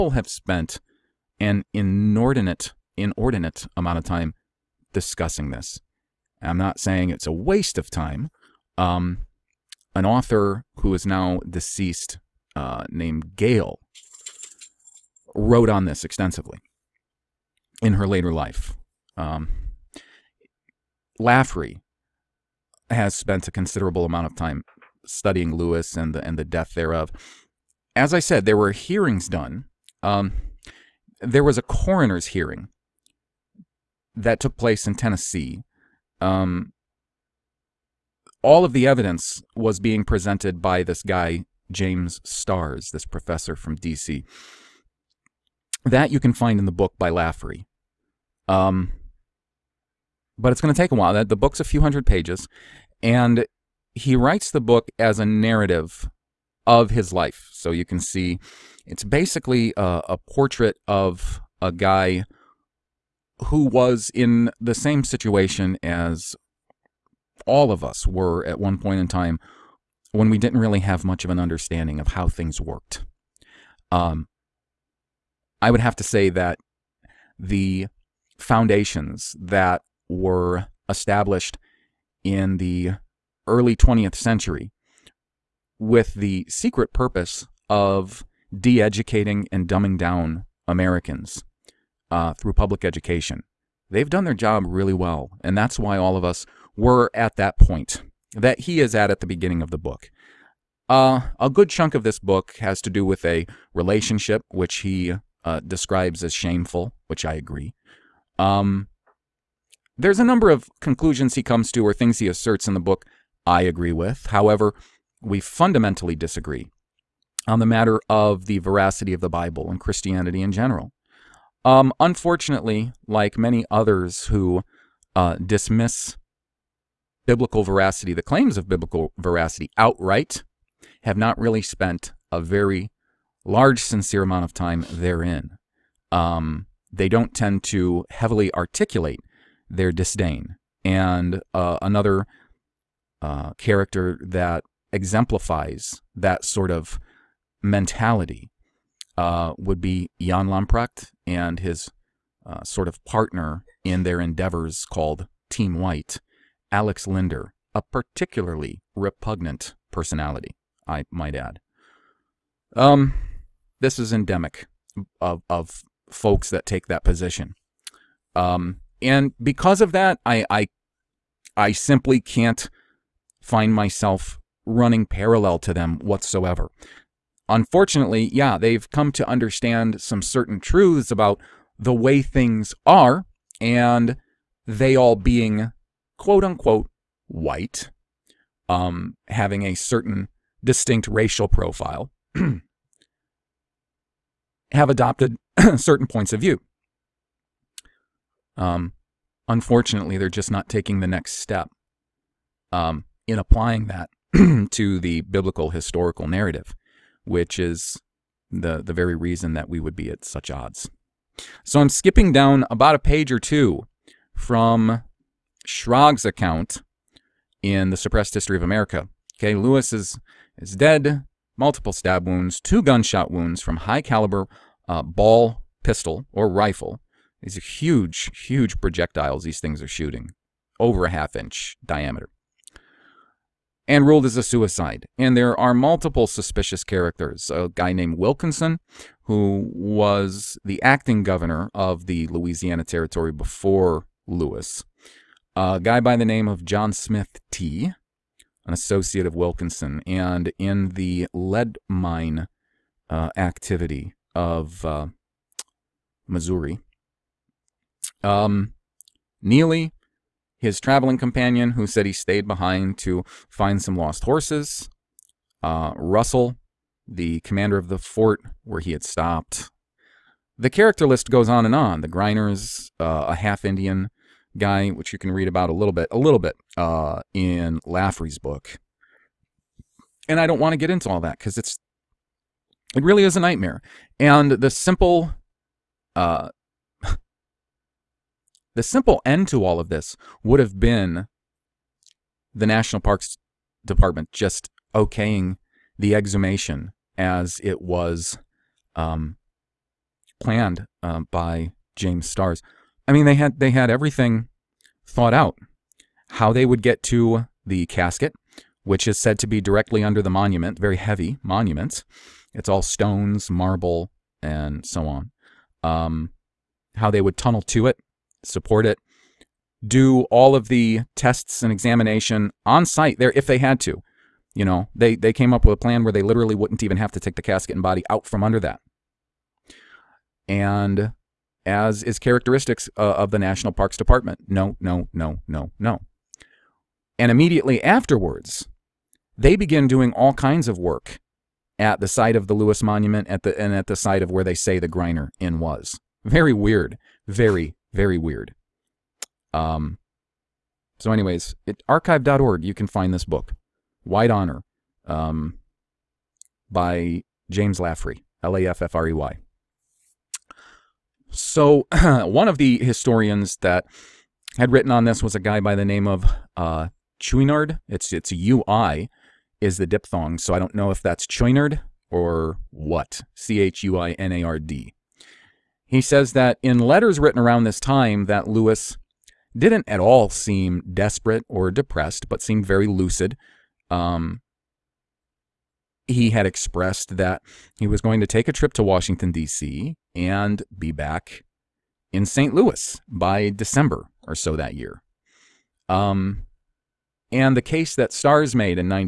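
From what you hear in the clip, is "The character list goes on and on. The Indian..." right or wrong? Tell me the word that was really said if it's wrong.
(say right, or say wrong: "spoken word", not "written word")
wrong: "Grinders", not "Indian".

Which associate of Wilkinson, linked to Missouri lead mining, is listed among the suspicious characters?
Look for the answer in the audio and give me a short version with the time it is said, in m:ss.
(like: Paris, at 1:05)
John Smith T, at 4:06.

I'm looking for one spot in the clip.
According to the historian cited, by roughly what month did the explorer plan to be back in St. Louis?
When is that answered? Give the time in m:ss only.
6:33.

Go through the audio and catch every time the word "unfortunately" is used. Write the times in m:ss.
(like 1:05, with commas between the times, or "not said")
2:01, 2:57, 3:19.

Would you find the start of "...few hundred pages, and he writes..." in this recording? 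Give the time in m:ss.
0:51.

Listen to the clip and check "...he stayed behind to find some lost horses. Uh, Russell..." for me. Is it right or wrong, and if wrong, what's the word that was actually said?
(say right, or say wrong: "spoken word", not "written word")
right.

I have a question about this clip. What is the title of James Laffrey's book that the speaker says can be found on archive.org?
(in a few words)
White Honor.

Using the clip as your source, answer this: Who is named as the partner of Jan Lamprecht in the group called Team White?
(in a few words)
Alex Linder.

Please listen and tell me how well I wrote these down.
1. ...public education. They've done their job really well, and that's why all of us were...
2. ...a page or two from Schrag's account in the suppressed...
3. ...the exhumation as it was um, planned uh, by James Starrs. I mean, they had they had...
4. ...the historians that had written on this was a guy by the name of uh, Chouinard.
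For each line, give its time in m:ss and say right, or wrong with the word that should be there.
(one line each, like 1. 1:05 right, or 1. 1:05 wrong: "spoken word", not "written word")
1. 1:32 right
2. 3:32 right
3. 4:55 right
4. 6:02 right.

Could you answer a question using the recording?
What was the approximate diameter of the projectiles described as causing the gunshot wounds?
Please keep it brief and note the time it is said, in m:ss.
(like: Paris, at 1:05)
over a half inch, at 3:50.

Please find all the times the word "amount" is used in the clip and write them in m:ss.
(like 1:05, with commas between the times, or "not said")
0:03, 0:24, 2:14.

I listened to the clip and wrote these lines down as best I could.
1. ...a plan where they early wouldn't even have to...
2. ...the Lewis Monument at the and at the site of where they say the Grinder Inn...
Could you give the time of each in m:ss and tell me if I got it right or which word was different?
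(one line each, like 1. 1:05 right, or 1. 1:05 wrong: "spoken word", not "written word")
1. 5:25 wrong: "literally", not "early"
2. 5:42 right.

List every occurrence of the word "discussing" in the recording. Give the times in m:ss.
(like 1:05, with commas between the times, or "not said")
0:04.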